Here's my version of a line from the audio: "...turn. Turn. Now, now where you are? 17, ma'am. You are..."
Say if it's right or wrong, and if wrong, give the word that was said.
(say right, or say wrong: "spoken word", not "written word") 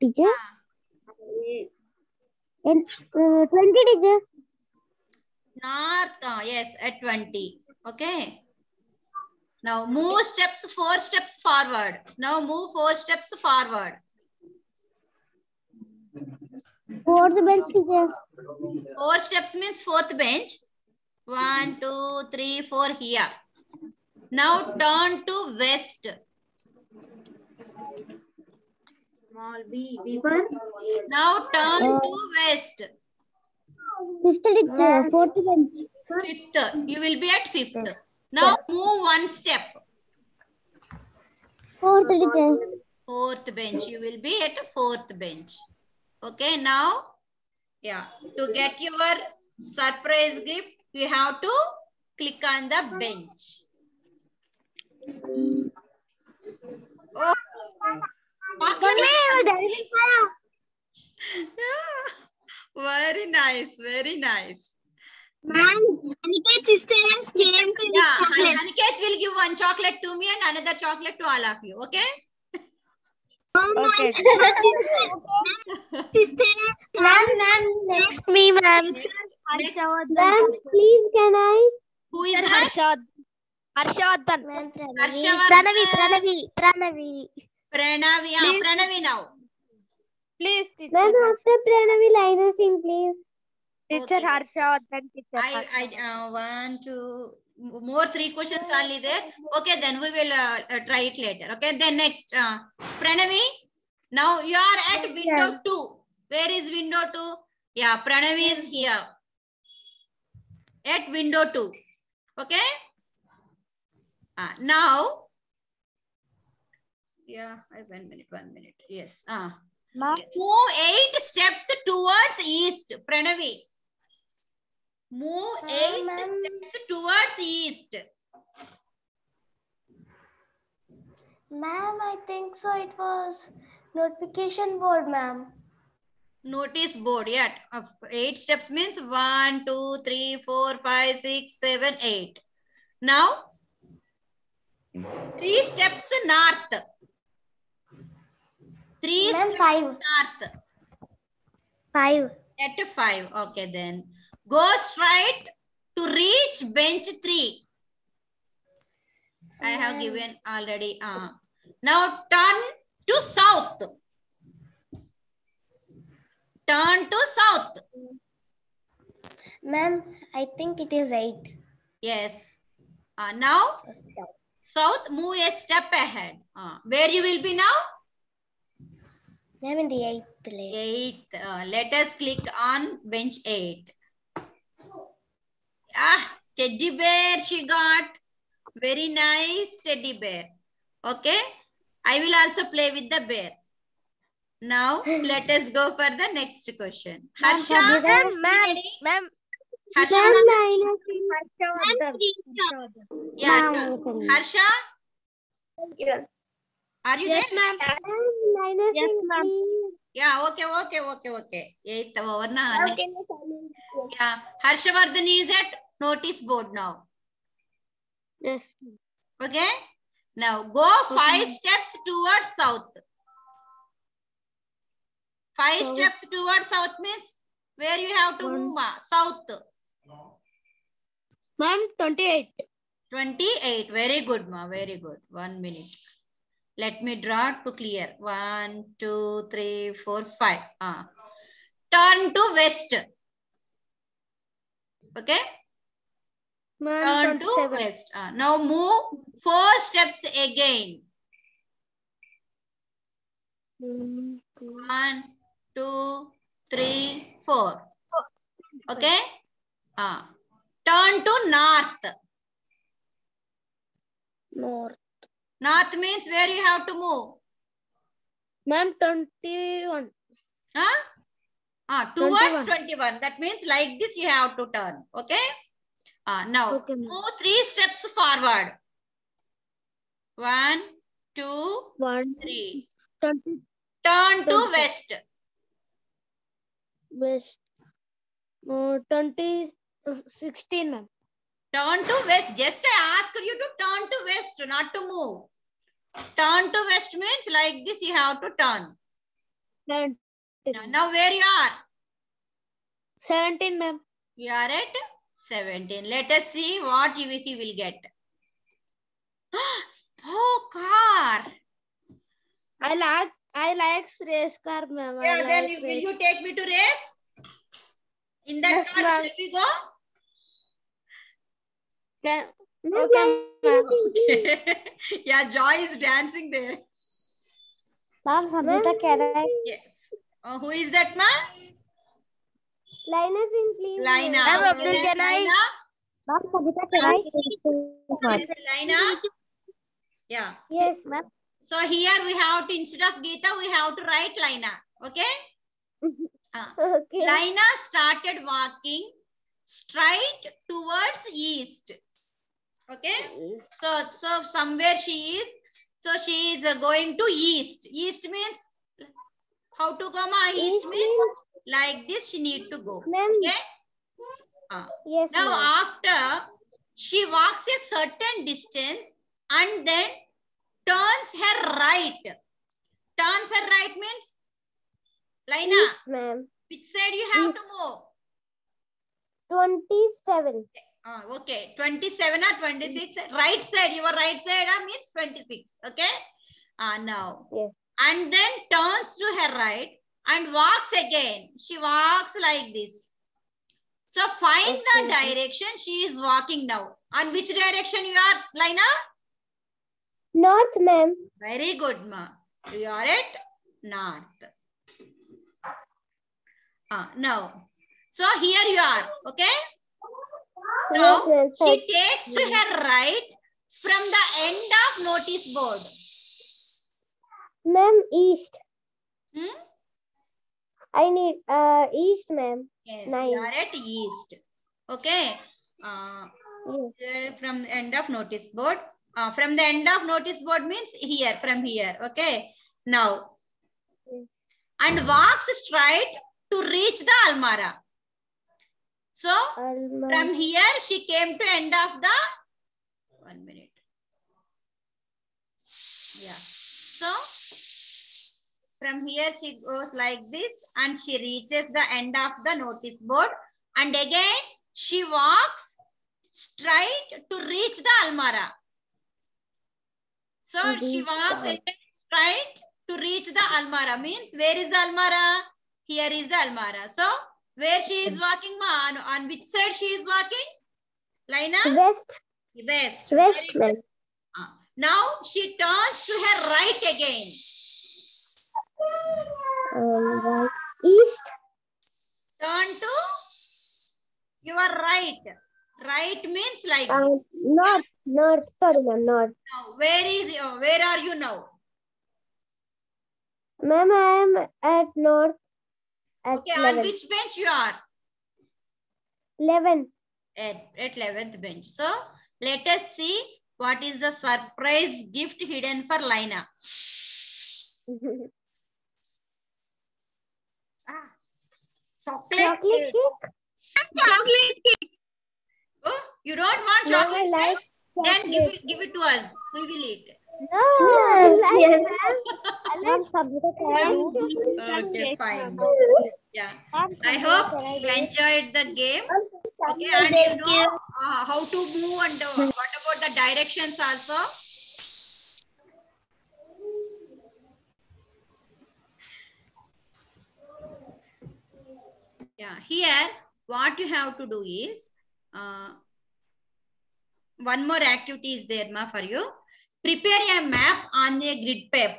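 right.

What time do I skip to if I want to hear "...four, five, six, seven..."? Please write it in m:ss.
2:20.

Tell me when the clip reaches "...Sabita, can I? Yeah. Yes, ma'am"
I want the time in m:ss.
5:36.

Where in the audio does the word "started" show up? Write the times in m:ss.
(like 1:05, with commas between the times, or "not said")
5:47.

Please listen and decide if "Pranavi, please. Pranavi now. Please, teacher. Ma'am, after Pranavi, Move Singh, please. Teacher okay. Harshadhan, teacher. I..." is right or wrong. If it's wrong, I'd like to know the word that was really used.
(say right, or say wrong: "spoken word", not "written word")
wrong: "Lina", not "Move".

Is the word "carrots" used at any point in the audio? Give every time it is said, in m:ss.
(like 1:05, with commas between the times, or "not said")
not said.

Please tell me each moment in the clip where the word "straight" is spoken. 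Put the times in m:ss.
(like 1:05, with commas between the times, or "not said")
2:34, 5:49, 7:15, 7:36, 7:42.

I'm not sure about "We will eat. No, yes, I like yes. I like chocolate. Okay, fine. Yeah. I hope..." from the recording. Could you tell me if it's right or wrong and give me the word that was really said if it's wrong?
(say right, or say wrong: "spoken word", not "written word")
right.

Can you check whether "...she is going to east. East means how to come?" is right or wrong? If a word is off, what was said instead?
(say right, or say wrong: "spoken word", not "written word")
right.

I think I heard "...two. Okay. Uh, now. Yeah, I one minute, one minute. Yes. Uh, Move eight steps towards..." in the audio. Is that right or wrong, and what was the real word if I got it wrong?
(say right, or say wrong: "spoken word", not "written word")
right.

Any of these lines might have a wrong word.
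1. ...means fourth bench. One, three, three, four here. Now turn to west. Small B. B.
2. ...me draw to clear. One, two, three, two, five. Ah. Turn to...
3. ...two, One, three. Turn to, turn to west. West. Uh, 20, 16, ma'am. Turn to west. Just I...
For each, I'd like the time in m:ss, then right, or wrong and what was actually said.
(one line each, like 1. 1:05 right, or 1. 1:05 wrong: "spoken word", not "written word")
1. 0:19 wrong: "two", not "three"
2. 3:57 wrong: "four", not "two"
3. 4:41 right.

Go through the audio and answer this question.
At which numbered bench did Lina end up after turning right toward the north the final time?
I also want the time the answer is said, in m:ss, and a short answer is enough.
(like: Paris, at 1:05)
11, at 8:20.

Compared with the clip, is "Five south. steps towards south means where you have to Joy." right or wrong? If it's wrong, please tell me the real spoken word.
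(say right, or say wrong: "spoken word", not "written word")
wrong: "One", not "Joy".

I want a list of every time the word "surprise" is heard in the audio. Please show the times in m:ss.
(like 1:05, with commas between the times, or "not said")
0:49, 8:24.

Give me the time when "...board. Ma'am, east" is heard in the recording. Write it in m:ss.
6:57.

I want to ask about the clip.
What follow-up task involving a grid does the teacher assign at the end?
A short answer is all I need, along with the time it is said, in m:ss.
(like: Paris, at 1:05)
Prepare a map, at 9:09.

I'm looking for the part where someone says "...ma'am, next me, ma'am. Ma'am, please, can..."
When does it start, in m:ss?
1:17.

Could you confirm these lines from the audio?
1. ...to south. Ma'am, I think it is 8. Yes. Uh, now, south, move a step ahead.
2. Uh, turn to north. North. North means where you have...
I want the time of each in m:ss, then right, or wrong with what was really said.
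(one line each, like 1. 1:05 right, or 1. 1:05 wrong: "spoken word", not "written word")
1. 2:47 right
2. 4:19 right.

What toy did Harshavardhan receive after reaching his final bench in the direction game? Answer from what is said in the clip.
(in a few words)
Race car.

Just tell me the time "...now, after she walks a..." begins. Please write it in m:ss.
6:05.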